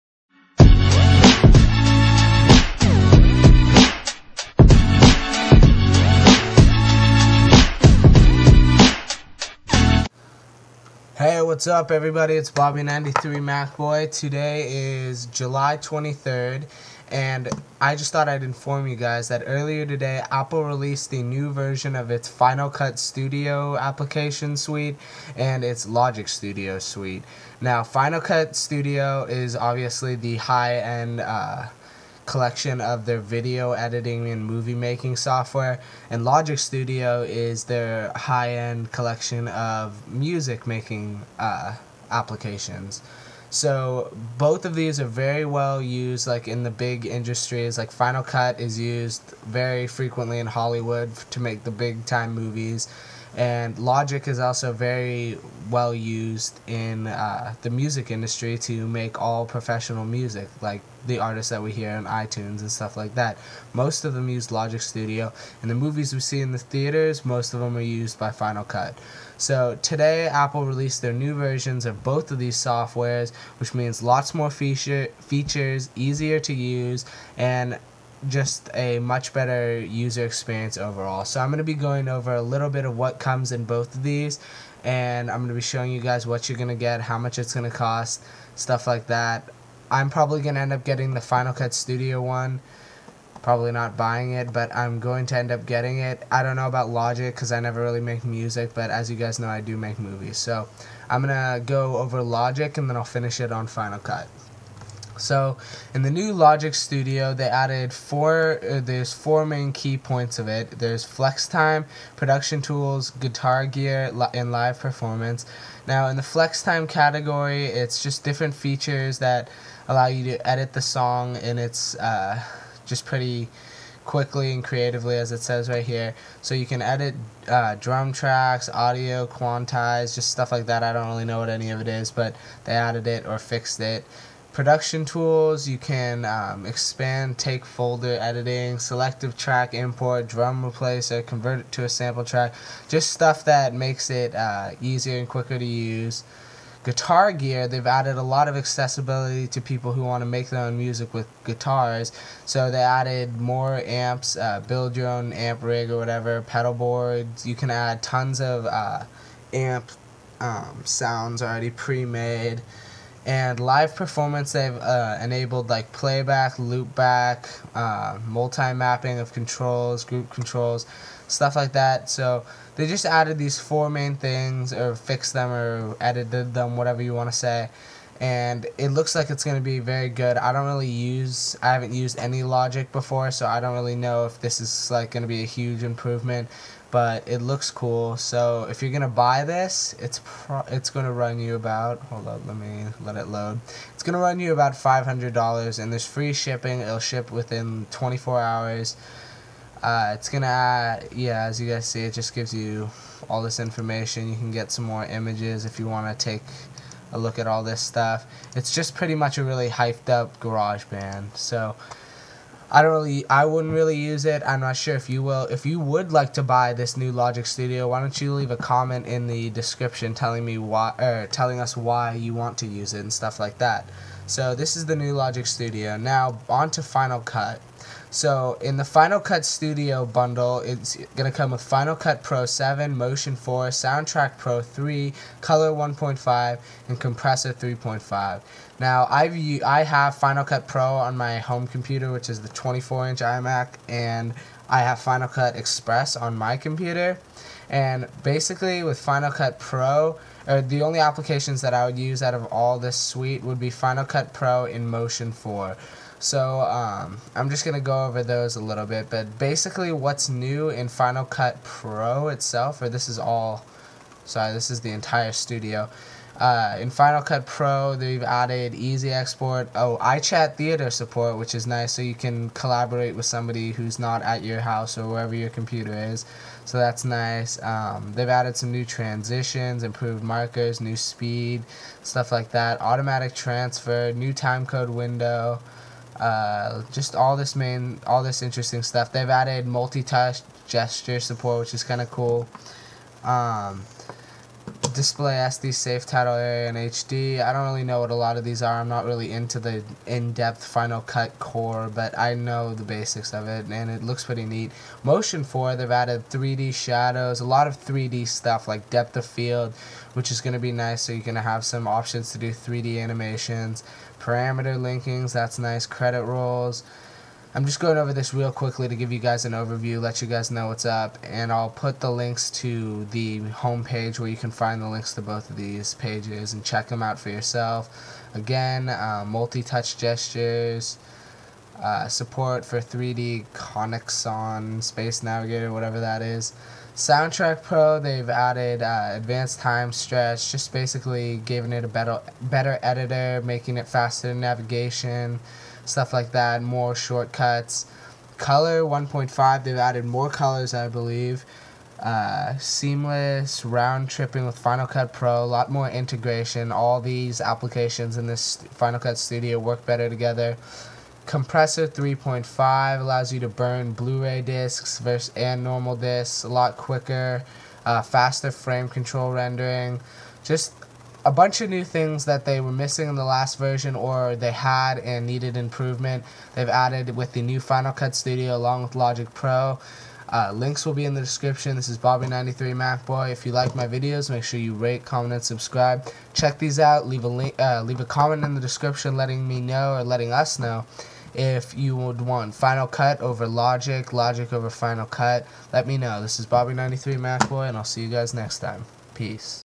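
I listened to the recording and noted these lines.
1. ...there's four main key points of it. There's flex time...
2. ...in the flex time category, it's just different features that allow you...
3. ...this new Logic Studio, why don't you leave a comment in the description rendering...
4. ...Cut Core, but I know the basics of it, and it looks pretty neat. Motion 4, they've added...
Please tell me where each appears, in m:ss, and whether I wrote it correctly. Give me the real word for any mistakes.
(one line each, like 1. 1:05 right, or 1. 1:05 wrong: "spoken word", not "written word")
1. 1:48 right
2. 1:56 right
3. 3:36 wrong: "telling", not "rendering"
4. 5:01 right.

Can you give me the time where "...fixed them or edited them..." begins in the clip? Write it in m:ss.
2:54.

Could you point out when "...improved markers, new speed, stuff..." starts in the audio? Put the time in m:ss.
4:39.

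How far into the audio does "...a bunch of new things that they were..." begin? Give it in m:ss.
6:11.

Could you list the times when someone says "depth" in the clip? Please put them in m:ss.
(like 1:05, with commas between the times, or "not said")
5:00, 5:08.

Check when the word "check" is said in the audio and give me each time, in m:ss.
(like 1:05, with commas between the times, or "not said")
5:26, 6:26.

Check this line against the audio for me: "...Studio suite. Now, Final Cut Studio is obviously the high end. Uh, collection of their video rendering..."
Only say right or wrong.
wrong.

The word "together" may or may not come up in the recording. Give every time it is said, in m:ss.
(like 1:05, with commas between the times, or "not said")
6:00.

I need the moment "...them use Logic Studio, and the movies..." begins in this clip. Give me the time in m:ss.
1:04.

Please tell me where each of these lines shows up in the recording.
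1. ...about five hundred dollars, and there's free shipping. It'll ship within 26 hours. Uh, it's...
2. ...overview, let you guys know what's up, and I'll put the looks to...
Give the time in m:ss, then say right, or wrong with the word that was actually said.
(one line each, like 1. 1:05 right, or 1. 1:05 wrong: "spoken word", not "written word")
1. 3:14 wrong: "24", not "26"
2. 5:19 wrong: "links", not "looks".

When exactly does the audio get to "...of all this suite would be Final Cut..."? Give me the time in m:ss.
4:12.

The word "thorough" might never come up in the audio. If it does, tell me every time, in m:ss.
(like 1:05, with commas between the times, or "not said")
not said.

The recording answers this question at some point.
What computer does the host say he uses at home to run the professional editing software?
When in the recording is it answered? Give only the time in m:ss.
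4:02.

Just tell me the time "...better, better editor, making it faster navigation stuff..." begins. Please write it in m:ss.
5:41.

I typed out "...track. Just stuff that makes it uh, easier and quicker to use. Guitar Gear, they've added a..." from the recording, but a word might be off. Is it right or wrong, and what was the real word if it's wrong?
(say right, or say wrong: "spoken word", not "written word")
right.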